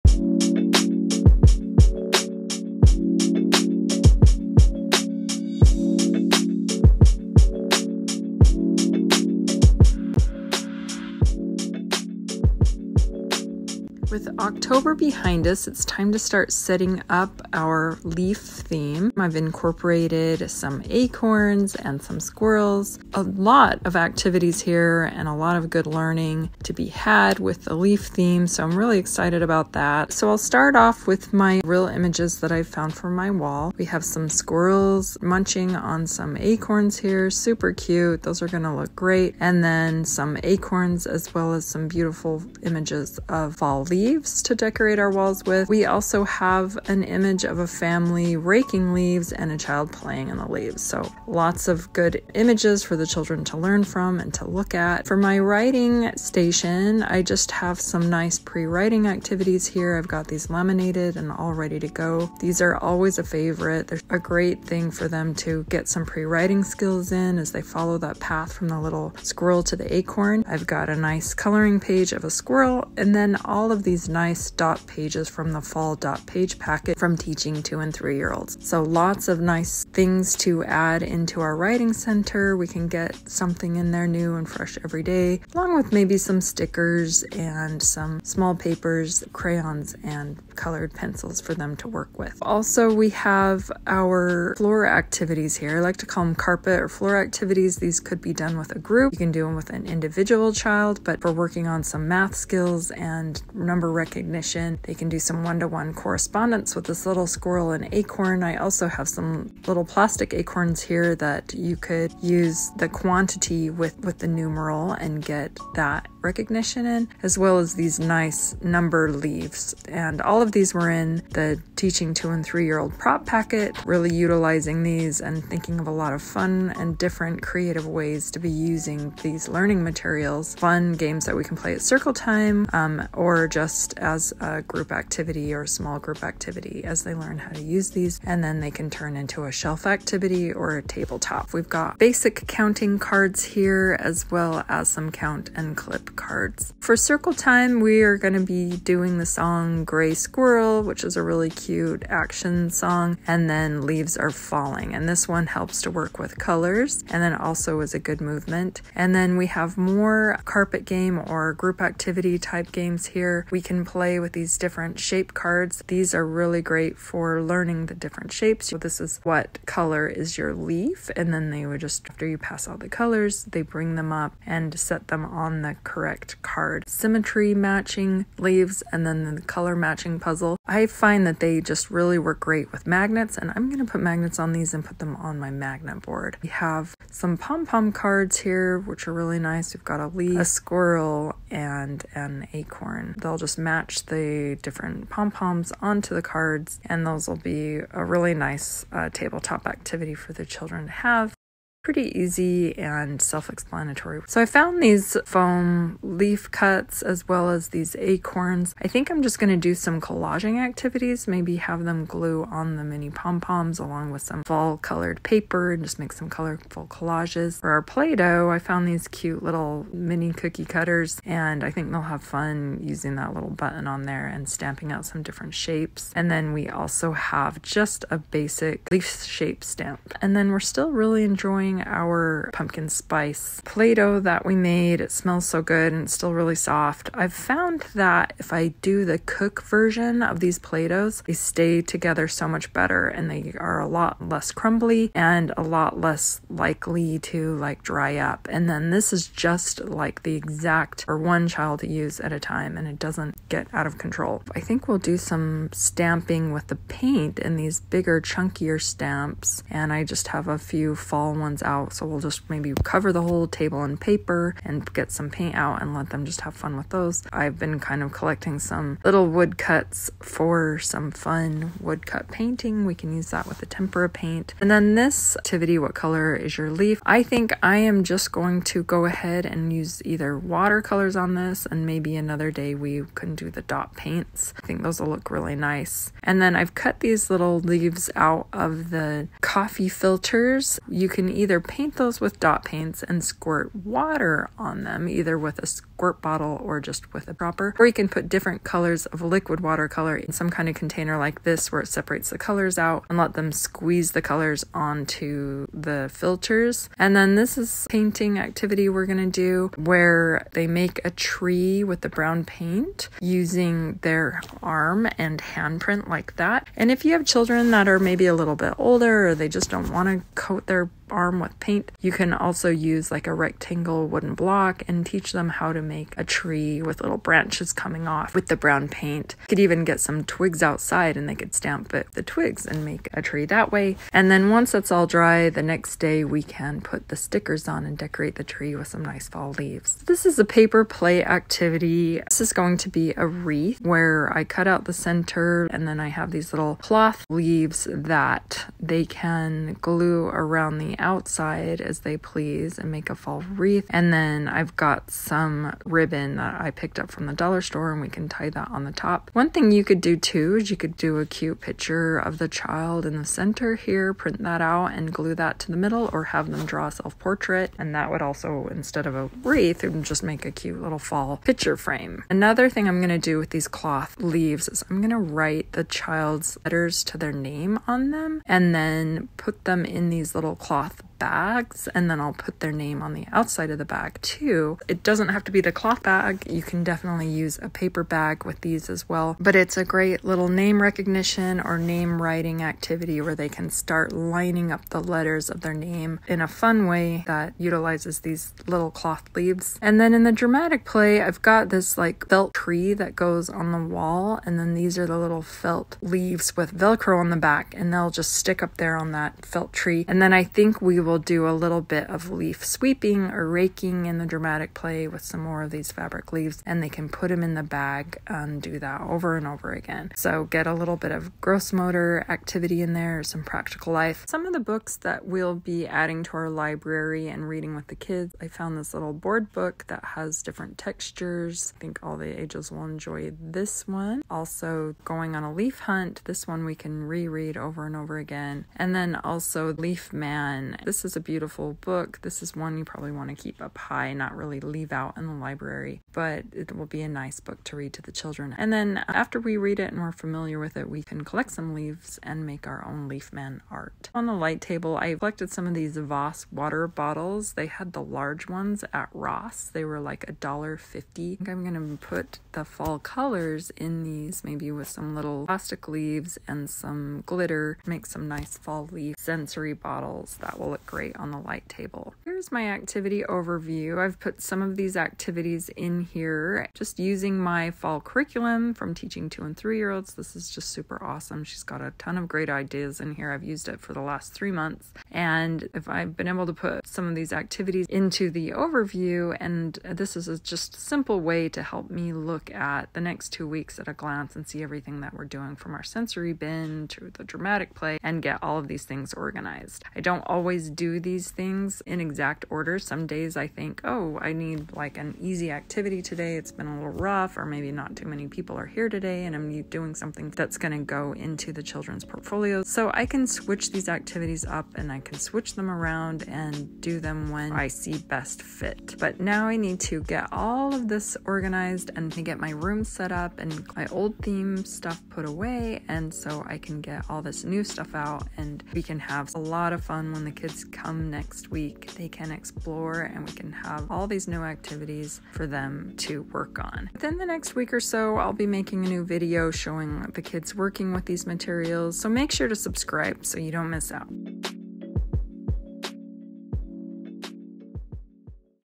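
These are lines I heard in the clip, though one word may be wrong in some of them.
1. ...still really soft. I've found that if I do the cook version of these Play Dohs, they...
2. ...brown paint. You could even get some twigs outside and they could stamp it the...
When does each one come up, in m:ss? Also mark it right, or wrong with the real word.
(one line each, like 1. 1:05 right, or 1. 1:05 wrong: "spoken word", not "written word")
1. 3:56 right
2. 5:28 right.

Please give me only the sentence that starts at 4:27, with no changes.
I've been kind of collecting some little woodcuts for some fun woodcut painting.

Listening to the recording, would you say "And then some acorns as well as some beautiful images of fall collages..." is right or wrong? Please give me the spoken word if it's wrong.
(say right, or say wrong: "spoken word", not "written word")
wrong: "leaves", not "collages".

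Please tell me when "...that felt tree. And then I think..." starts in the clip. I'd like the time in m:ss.
6:49.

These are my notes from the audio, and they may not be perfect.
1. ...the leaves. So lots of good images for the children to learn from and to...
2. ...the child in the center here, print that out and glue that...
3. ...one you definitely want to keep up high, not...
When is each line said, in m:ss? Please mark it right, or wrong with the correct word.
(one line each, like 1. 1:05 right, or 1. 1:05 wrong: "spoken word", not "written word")
1. 0:50 right
2. 6:02 right
3. 7:22 wrong: "probably", not "definitely".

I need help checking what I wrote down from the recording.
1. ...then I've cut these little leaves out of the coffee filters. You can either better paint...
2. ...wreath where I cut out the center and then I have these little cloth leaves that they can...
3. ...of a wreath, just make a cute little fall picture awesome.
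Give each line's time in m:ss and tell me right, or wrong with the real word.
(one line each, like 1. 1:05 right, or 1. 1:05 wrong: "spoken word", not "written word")
1. 4:46 wrong: "either", not "better"
2. 5:43 right
3. 6:09 wrong: "frame", not "awesome".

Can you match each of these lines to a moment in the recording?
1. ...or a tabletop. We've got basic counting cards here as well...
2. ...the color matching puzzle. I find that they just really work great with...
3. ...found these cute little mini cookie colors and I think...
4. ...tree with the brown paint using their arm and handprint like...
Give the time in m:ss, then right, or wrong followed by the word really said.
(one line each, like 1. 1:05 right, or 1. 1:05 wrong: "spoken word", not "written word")
1. 2:20 right
2. 2:59 right
3. 3:38 wrong: "cutters", not "colors"
4. 5:11 right.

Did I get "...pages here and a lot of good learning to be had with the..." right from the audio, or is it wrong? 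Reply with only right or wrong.
wrong.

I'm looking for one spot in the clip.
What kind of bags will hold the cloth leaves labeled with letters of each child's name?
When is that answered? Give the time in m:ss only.
6:20.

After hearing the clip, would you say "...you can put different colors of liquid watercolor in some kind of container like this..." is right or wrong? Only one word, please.
right.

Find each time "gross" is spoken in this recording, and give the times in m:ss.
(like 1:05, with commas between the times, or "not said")
7:01.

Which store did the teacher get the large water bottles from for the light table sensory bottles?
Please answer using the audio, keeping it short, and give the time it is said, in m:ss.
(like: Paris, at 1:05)
Ross, at 7:39.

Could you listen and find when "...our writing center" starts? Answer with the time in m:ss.
1:21.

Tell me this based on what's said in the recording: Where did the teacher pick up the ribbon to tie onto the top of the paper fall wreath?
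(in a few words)
dollar store.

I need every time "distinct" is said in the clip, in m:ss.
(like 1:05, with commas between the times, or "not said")
not said.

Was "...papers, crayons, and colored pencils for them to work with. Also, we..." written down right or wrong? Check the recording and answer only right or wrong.
right.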